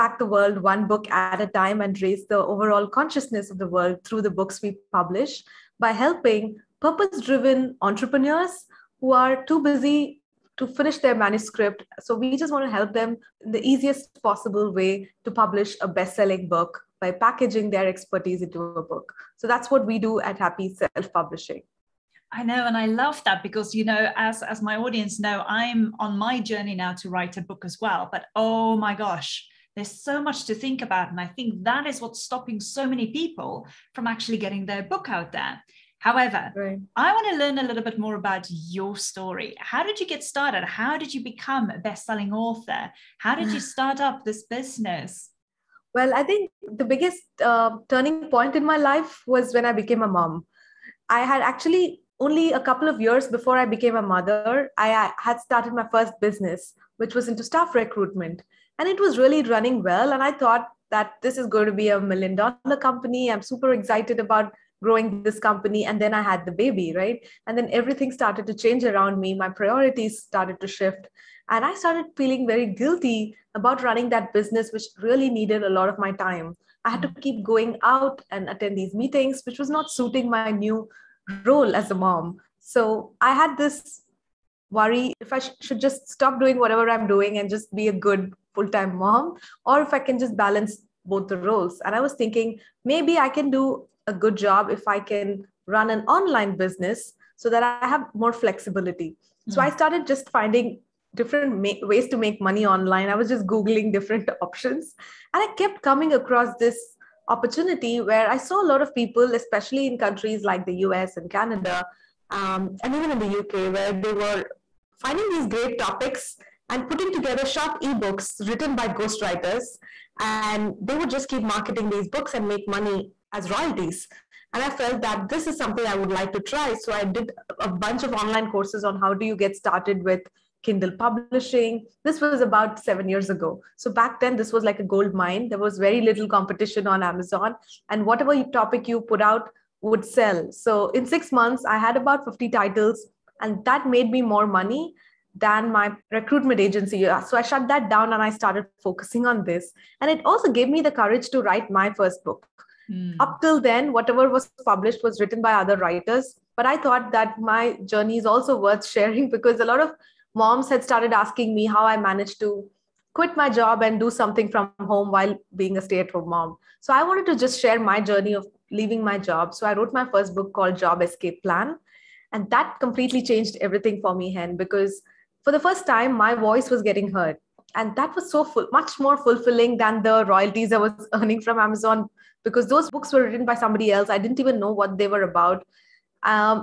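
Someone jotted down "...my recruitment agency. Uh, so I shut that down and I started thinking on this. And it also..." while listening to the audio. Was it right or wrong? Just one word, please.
wrong.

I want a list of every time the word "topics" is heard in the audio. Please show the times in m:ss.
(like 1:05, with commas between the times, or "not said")
1:55, 2:18.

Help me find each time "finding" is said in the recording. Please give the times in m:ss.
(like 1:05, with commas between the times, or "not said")
1:40, 1:54.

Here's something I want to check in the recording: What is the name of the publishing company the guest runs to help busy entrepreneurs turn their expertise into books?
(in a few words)
Happy Self Publishing.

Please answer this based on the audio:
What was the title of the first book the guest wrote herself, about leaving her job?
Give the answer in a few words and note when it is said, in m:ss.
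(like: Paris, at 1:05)
Job Escape Plan, at 2:50.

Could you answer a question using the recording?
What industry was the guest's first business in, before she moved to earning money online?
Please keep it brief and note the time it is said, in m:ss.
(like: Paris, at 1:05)
Staff recruitment, at 0:57.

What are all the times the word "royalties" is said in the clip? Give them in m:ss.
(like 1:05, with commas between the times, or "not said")
2:03, 3:00.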